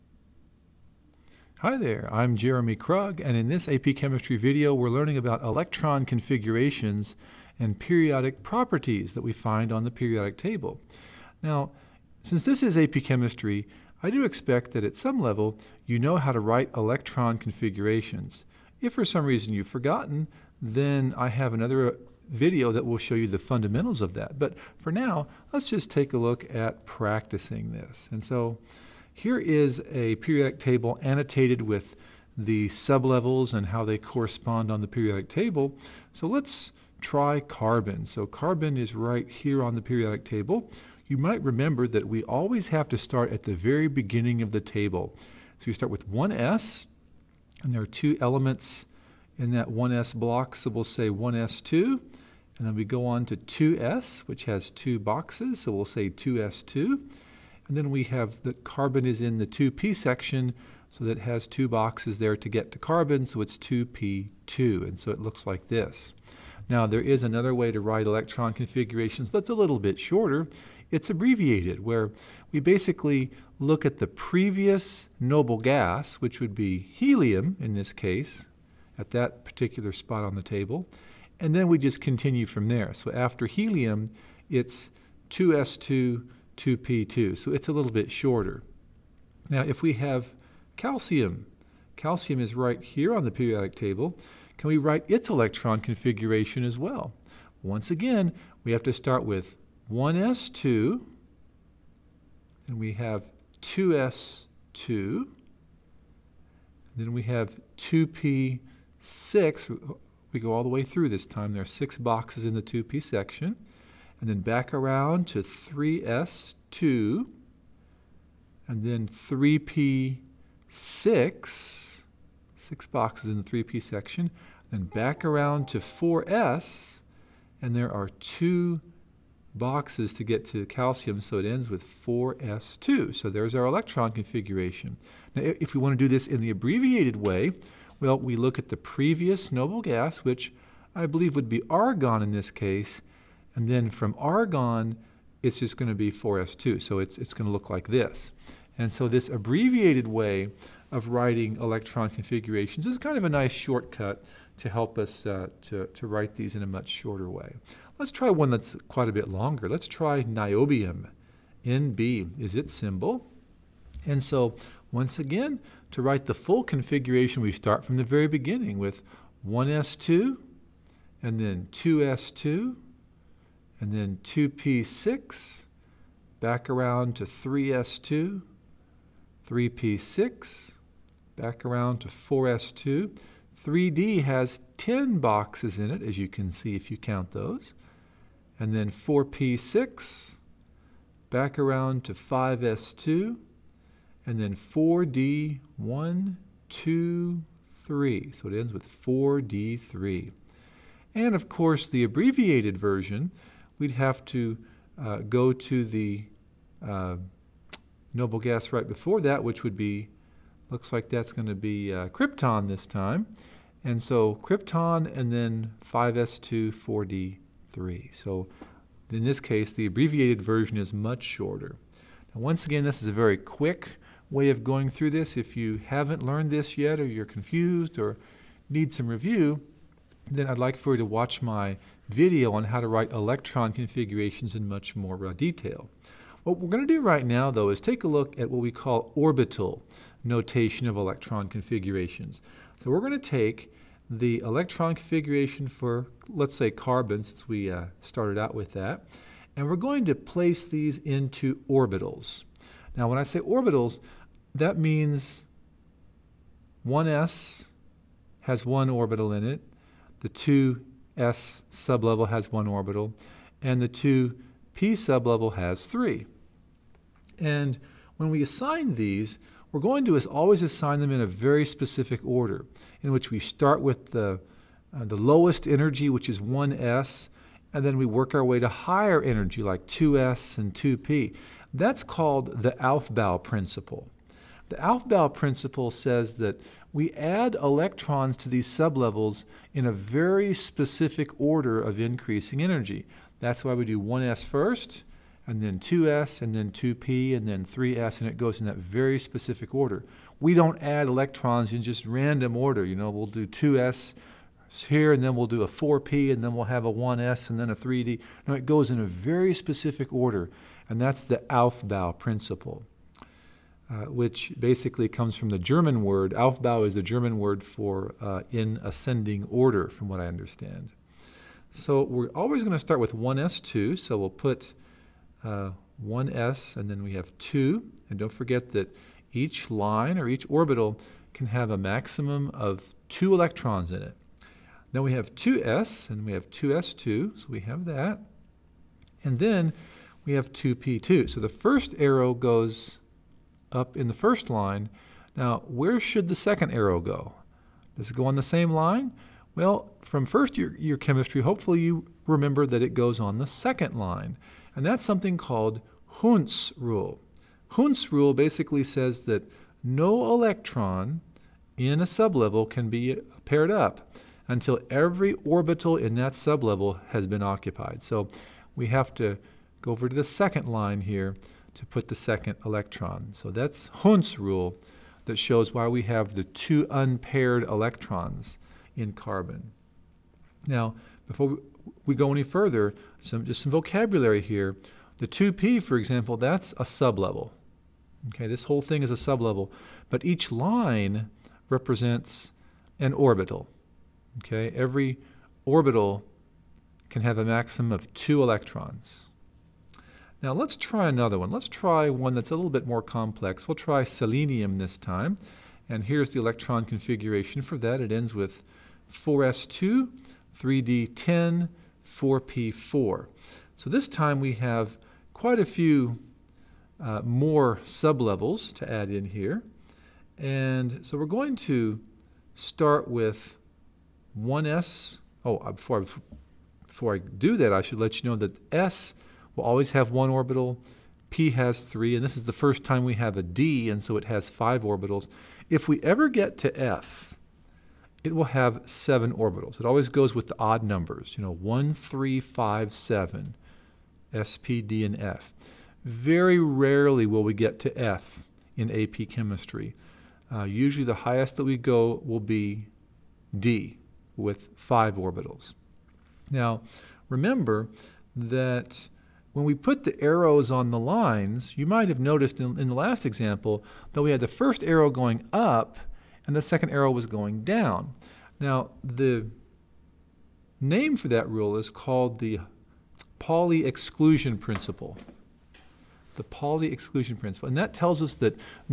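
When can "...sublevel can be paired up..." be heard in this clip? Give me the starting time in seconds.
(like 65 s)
362 s.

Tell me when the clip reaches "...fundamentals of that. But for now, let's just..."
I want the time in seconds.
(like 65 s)
23 s.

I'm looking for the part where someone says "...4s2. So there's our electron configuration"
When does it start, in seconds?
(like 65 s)
131 s.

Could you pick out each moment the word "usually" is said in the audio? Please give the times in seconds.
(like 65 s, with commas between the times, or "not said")
450 s.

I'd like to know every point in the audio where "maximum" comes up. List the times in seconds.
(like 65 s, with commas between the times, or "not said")
331 s, 397 s.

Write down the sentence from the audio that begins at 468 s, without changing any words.
Now, the name for that rule is called the Pauli exclusion principle.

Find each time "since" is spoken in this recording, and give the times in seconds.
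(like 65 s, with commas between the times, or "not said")
12 s, 247 s.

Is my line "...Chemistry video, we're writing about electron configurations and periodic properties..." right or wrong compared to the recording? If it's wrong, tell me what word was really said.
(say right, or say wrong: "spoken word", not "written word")
wrong: "learning", not "writing".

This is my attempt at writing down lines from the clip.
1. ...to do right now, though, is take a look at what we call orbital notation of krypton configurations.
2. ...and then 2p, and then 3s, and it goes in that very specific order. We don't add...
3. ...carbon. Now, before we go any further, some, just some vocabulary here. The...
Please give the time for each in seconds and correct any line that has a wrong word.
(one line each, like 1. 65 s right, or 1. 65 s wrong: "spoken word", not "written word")
1. 236 s wrong: "electron", not "krypton"
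2. 296 s right
3. 379 s right.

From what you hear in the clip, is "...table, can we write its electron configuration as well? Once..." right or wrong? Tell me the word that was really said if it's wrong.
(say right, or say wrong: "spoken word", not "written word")
right.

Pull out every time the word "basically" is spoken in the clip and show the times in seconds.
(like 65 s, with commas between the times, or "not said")
72 s, 314 s, 358 s.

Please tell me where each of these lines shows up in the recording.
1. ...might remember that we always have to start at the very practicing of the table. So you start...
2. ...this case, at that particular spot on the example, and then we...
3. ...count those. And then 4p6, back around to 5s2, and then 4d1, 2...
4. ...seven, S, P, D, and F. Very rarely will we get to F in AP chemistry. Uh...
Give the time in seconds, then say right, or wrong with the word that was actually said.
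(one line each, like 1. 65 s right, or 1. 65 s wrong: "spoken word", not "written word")
1. 41 s wrong: "beginning", not "practicing"
2. 77 s wrong: "table", not "example"
3. 186 s right
4. 442 s right.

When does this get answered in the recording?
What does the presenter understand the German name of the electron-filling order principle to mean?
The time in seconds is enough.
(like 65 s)
318 s.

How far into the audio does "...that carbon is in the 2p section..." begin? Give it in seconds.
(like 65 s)
58 s.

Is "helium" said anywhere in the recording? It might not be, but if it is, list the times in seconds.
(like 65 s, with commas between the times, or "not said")
76 s, 83 s.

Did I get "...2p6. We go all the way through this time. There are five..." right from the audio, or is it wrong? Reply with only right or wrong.
wrong.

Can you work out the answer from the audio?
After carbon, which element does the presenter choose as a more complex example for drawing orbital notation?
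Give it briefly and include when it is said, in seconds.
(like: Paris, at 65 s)
selenium, at 404 s.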